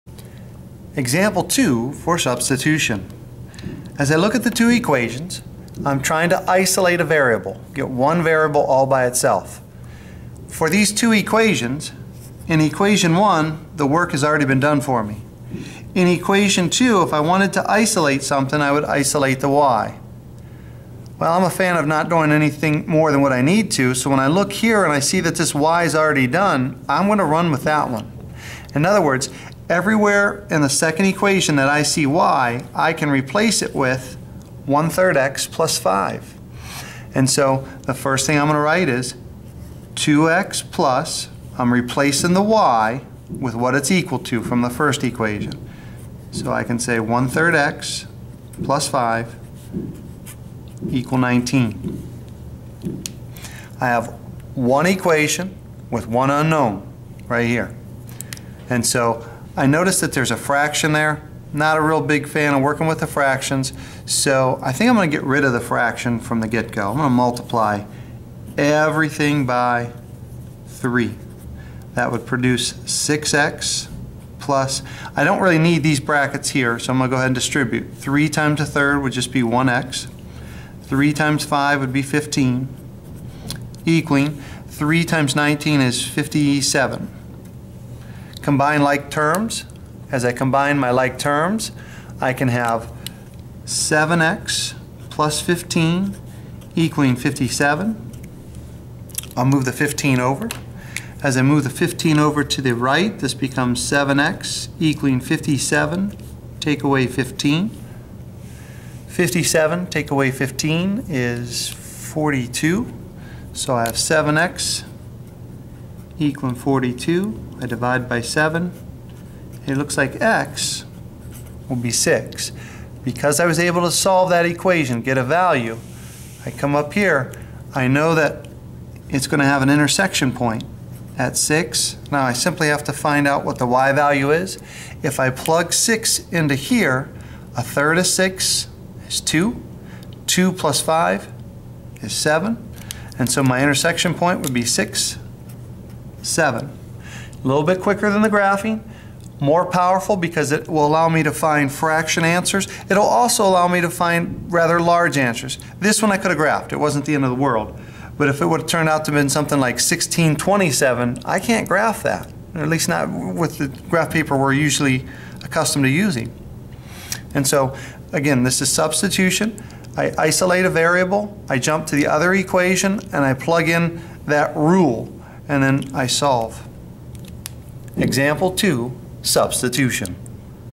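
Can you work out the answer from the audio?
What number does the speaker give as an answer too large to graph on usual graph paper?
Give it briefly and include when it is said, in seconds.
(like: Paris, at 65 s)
1627, at 159 s.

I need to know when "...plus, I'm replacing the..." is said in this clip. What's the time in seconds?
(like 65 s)
40 s.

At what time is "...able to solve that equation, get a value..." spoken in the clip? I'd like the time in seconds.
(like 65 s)
123 s.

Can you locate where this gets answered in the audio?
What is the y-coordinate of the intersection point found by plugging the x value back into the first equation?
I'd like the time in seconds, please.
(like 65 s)
146 s.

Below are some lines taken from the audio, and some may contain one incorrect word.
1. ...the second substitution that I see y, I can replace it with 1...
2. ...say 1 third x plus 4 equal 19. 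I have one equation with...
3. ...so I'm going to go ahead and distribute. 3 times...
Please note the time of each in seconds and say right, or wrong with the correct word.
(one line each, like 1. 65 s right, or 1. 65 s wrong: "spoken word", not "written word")
1. 30 s wrong: "equation", not "substitution"
2. 46 s wrong: "5", not "4"
3. 76 s right.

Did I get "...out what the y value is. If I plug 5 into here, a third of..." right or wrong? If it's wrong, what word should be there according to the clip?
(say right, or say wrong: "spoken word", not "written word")
wrong: "6", not "5".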